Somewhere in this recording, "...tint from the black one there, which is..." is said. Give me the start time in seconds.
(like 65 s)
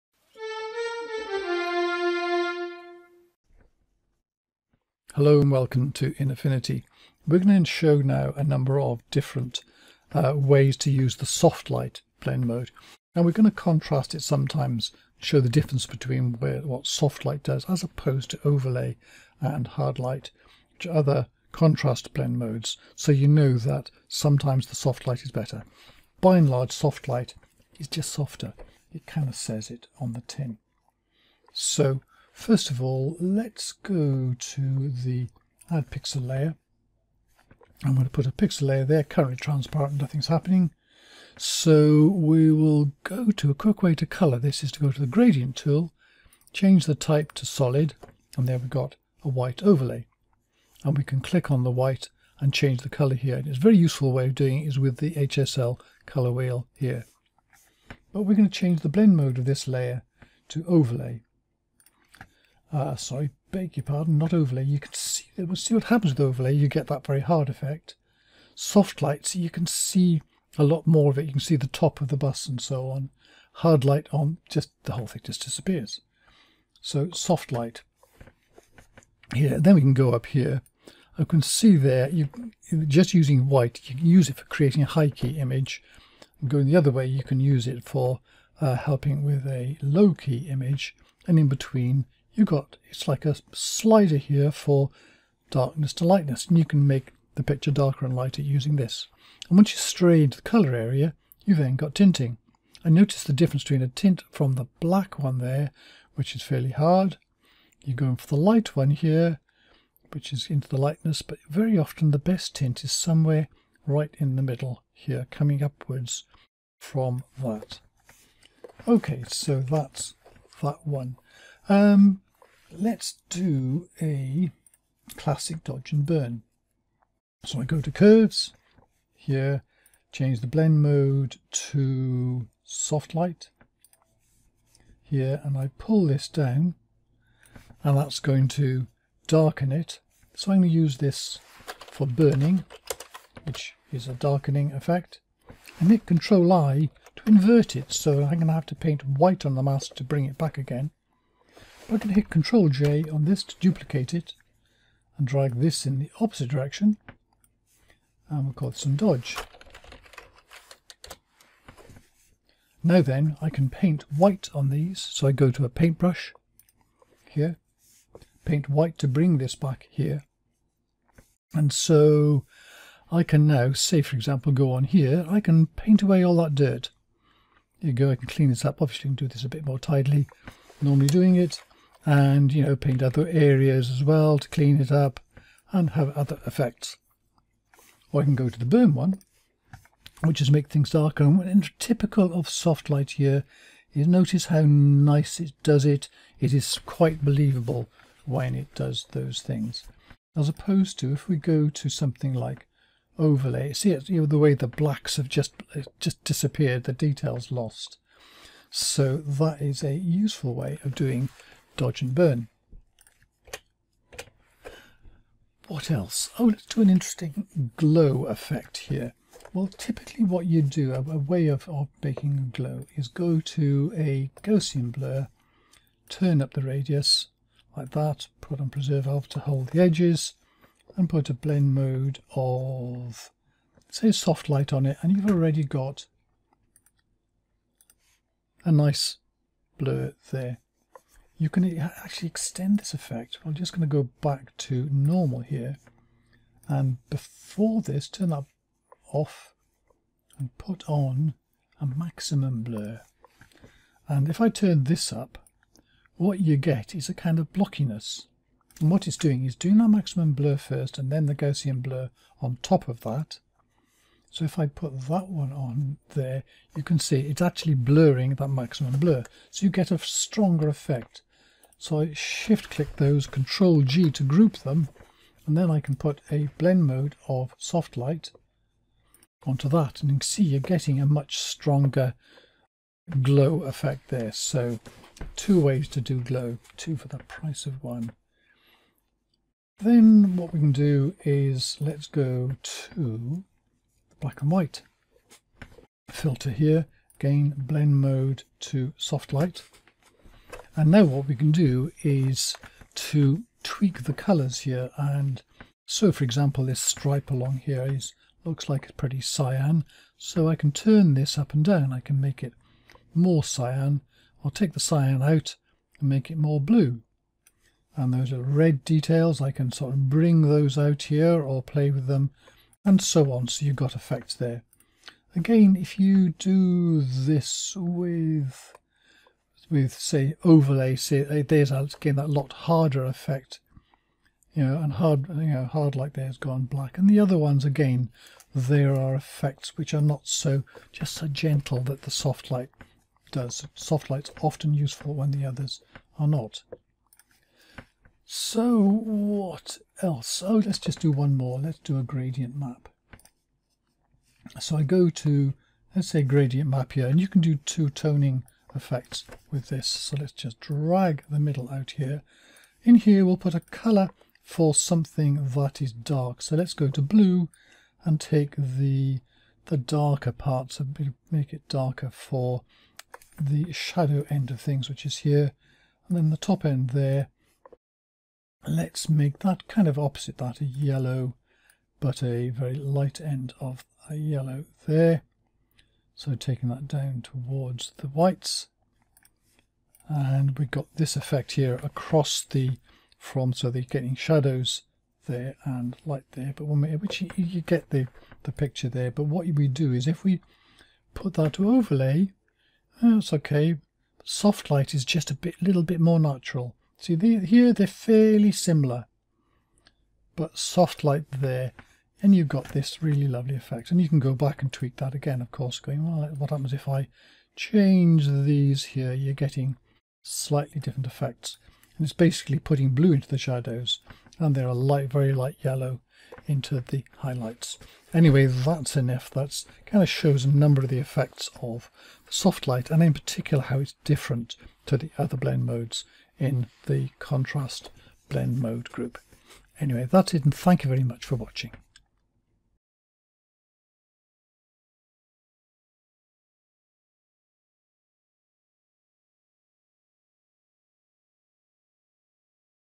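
103 s.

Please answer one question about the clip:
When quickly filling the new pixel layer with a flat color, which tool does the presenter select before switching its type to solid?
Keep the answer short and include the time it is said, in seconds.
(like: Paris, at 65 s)
Gradient tool, at 45 s.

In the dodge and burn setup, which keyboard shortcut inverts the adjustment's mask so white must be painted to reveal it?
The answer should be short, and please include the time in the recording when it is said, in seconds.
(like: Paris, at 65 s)
Control I, at 146 s.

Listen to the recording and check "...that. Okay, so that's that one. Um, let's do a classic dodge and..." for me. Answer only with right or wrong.
right.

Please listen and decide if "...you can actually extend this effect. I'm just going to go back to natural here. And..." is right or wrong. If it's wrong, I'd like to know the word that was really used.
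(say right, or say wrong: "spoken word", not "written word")
wrong: "normal", not "natural".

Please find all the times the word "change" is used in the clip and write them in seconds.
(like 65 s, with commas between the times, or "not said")
46 s, 52 s, 58 s, 130 s, 417 s.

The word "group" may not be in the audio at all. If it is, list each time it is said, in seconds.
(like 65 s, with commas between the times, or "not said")
274 s, 438 s.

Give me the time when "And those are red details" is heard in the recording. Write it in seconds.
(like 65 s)
317 s.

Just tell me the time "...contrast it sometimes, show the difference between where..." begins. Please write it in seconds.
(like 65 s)
13 s.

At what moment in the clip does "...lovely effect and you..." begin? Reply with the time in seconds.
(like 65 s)
413 s.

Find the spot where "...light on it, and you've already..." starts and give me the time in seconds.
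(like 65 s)
234 s.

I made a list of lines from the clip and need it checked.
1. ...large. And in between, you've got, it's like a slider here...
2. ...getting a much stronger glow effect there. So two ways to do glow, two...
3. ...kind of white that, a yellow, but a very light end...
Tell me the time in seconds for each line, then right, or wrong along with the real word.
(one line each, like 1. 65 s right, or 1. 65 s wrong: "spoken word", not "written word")
1. 90 s wrong: "image", not "large"
2. 280 s right
3. 379 s wrong: "opposite", not "white".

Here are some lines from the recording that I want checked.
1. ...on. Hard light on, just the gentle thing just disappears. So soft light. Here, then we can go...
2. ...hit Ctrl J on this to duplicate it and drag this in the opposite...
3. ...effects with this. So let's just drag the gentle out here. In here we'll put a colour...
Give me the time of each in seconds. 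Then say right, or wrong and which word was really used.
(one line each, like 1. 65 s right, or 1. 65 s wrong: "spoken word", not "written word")
1. 72 s wrong: "whole", not "gentle"
2. 152 s right
3. 358 s wrong: "middle", not "gentle".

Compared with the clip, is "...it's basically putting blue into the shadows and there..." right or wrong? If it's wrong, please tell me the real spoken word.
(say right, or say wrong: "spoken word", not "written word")
right.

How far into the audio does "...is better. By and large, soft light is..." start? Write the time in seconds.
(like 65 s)
25 s.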